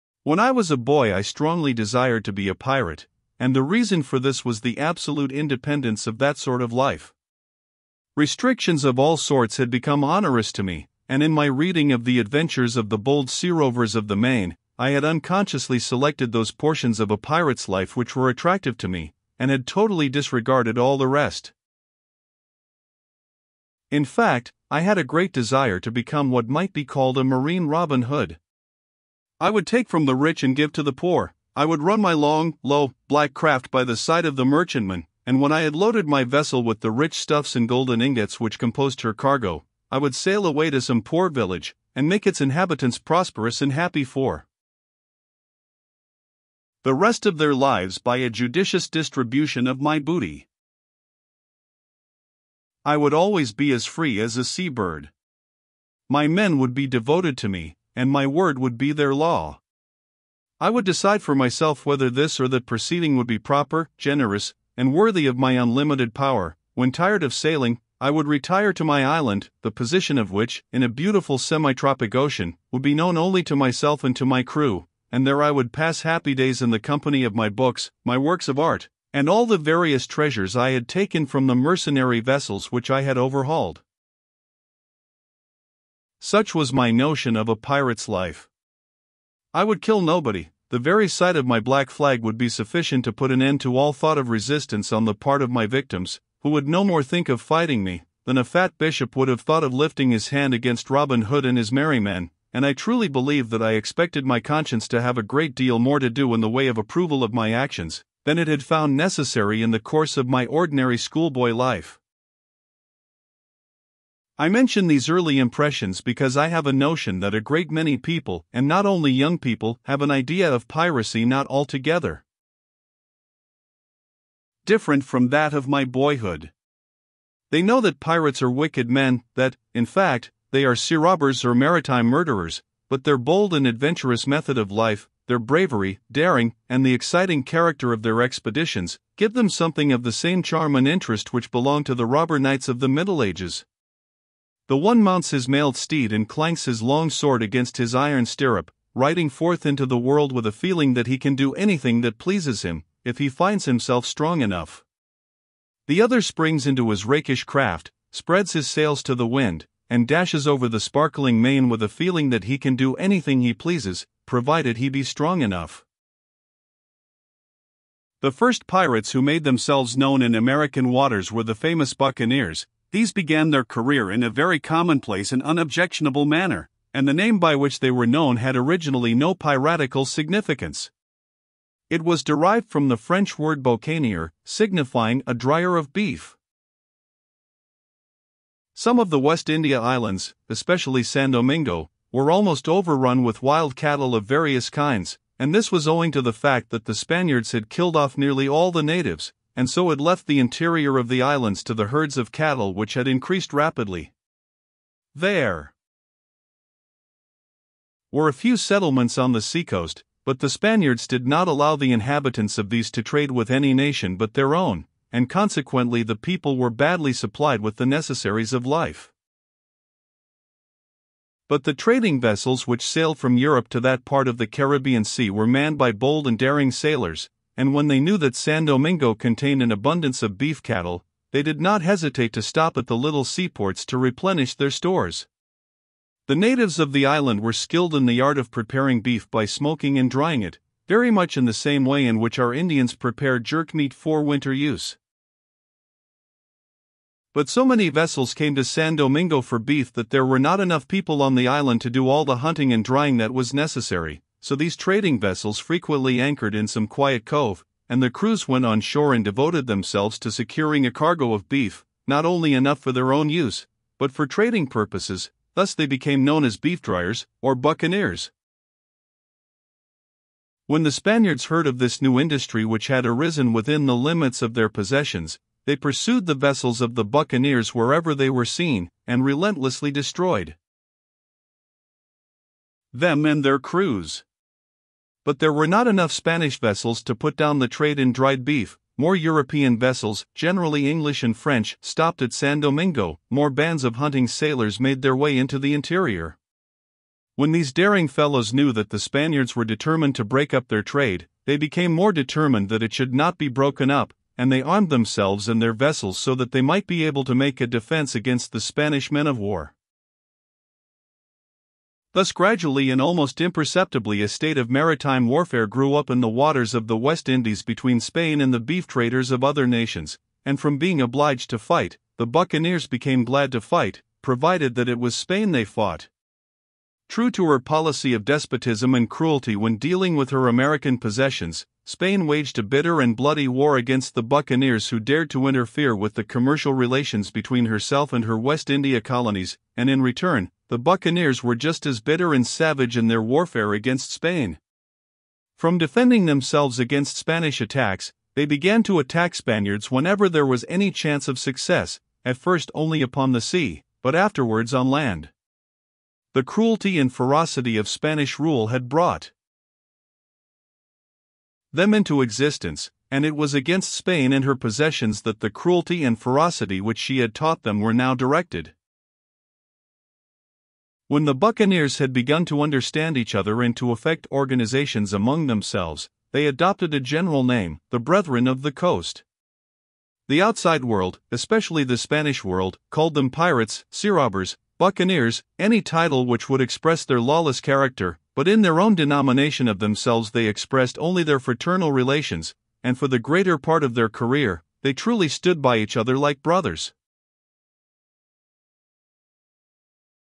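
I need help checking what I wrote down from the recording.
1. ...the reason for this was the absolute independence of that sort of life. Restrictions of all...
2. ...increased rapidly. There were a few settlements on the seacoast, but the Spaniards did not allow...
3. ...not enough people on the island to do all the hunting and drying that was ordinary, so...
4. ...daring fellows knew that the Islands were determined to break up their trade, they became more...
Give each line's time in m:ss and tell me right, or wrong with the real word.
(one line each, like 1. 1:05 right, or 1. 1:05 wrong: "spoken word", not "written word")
1. 0:03 right
2. 3:23 right
3. 4:10 wrong: "necessary", not "ordinary"
4. 4:57 wrong: "Spaniards", not "Islands".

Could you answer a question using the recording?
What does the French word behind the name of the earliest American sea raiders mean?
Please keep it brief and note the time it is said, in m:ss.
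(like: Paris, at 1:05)
a dryer of beef, at 3:05.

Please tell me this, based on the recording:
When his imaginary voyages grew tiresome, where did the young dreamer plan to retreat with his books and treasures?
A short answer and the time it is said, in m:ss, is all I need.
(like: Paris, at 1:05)
my island, at 1:08.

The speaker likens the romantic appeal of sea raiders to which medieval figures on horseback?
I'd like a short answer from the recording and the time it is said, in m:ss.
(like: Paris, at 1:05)
robber knights, at 2:22.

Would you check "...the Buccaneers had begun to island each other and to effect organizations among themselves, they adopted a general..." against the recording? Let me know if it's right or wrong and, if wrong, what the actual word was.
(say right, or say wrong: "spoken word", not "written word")
wrong: "understand", not "island".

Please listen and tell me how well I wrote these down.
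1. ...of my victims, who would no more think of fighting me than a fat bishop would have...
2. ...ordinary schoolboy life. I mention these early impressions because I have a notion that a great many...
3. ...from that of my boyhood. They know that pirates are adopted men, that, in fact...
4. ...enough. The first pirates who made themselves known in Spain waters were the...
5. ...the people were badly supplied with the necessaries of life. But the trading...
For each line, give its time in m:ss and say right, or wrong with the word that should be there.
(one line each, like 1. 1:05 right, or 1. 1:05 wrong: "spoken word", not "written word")
1. 1:35 right
2. 1:50 right
3. 2:05 wrong: "wicked", not "adopted"
4. 2:45 wrong: "American", not "Spain"
5. 3:36 right.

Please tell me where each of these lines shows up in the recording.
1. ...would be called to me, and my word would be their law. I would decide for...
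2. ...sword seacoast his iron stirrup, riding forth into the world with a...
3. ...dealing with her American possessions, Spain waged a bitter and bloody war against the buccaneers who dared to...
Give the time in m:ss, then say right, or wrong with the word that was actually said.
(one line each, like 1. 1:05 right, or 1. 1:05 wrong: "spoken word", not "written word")
1. 0:56 wrong: "devoted", not "called"
2. 2:27 wrong: "against", not "seacoast"
3. 5:29 right.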